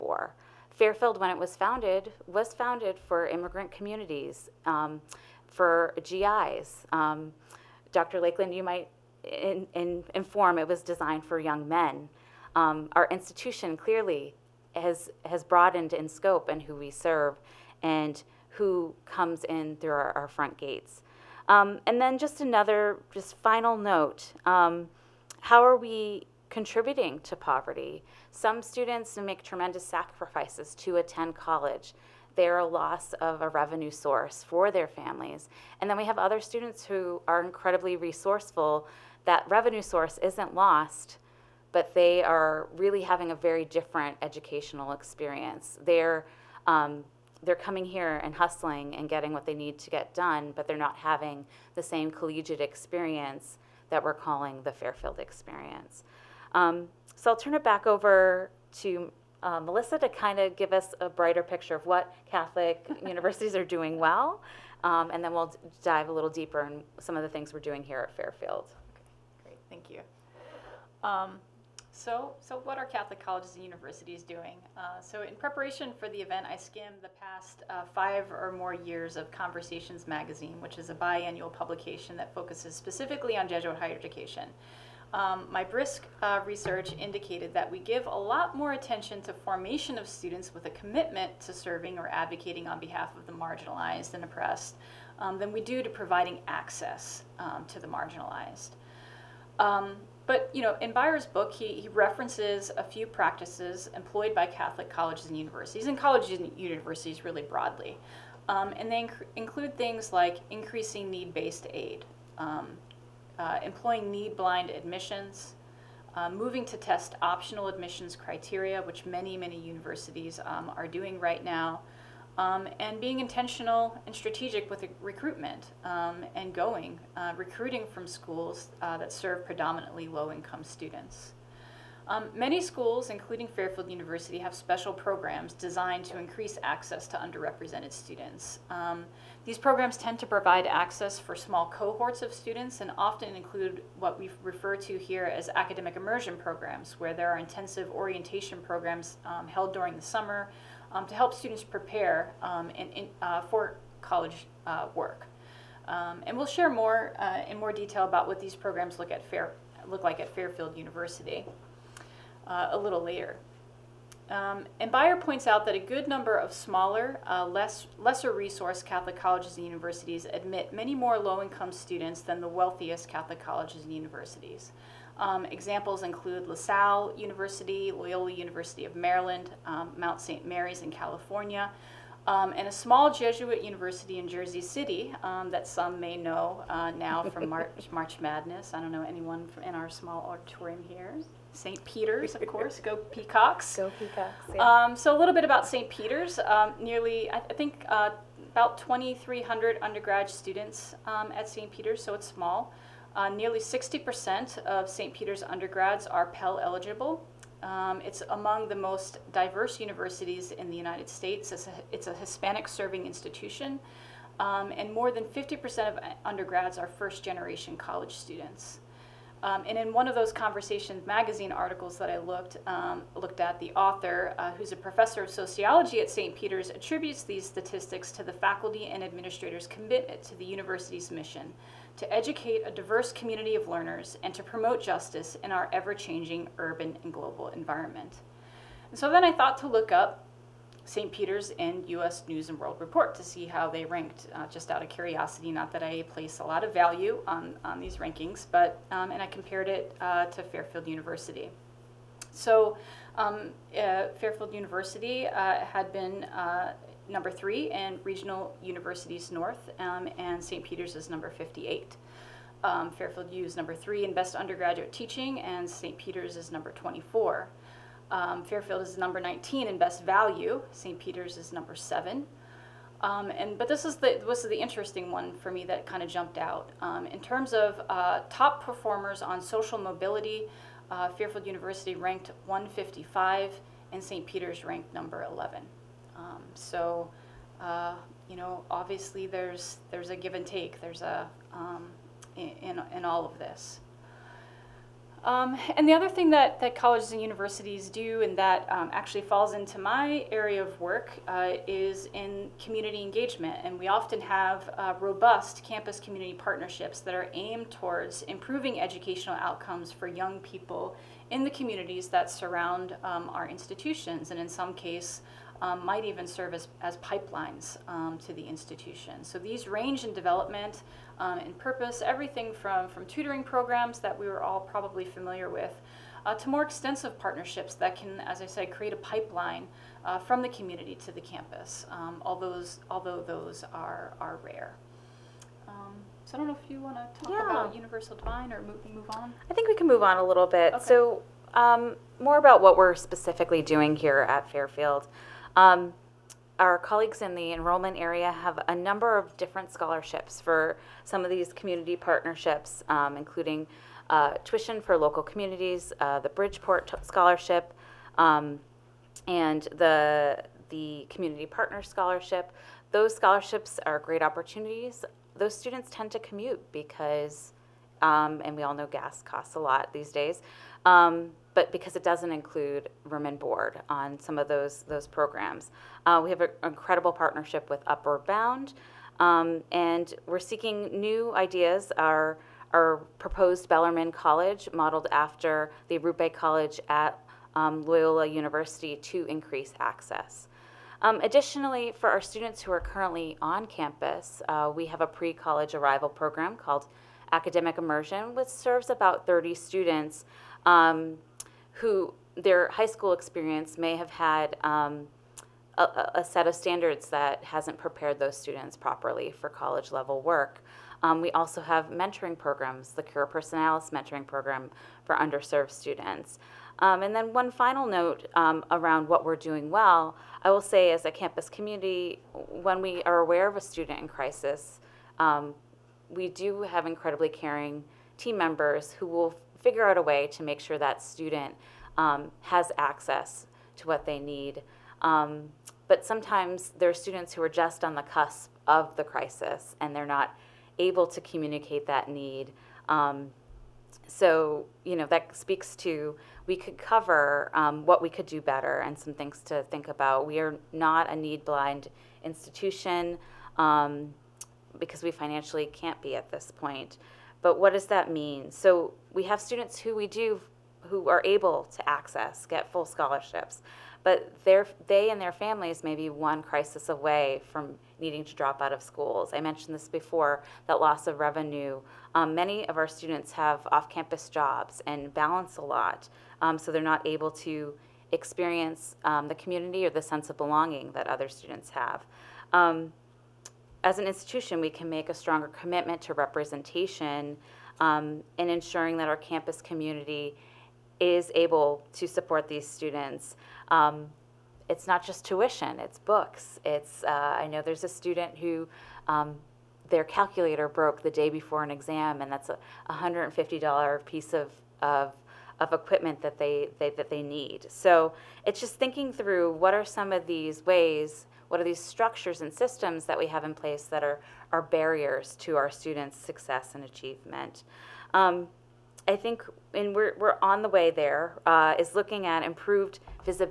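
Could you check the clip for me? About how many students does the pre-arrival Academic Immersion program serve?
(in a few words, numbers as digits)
30.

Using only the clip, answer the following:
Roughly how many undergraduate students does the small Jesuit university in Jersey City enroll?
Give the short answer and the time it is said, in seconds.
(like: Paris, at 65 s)
2,300, at 198 s.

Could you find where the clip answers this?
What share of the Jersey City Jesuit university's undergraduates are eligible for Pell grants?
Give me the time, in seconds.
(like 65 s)
203 s.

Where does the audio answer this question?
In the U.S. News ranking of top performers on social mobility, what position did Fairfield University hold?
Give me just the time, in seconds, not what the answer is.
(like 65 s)
282 s.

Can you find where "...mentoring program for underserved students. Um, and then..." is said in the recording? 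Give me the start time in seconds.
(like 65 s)
413 s.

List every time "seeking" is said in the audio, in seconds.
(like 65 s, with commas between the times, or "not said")
380 s.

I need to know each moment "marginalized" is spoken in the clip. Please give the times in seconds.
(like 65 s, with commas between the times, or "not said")
93 s, 97 s.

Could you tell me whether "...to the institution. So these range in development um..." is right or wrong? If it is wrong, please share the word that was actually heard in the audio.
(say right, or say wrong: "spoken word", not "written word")
right.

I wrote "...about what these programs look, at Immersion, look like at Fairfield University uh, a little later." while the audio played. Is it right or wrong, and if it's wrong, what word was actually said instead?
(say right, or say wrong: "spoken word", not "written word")
wrong: "Fair", not "Immersion".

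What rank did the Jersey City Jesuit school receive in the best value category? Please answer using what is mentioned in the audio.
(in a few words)
7.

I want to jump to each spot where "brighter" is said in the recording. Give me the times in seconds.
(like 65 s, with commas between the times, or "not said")
61 s.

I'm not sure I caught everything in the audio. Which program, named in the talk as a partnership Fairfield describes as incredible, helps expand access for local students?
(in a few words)
Upward Bound.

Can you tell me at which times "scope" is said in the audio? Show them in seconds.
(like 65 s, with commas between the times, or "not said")
16 s.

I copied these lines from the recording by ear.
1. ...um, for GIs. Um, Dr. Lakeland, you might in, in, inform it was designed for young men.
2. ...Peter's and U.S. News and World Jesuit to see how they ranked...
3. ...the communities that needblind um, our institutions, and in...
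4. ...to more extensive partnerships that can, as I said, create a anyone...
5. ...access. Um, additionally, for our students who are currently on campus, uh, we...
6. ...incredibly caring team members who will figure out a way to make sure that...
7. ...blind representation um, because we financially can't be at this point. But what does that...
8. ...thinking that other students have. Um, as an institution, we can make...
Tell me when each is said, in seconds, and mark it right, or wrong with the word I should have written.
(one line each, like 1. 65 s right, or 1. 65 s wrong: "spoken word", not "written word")
1. 4 s right
2. 241 s wrong: "Report", not "Jesuit"
3. 311 s wrong: "surround", not "needblind"
4. 326 s wrong: "pipeline", not "anyone"
5. 389 s right
6. 426 s right
7. 451 s wrong: "institution", not "representation"
8. 480 s wrong: "belonging", not "thinking".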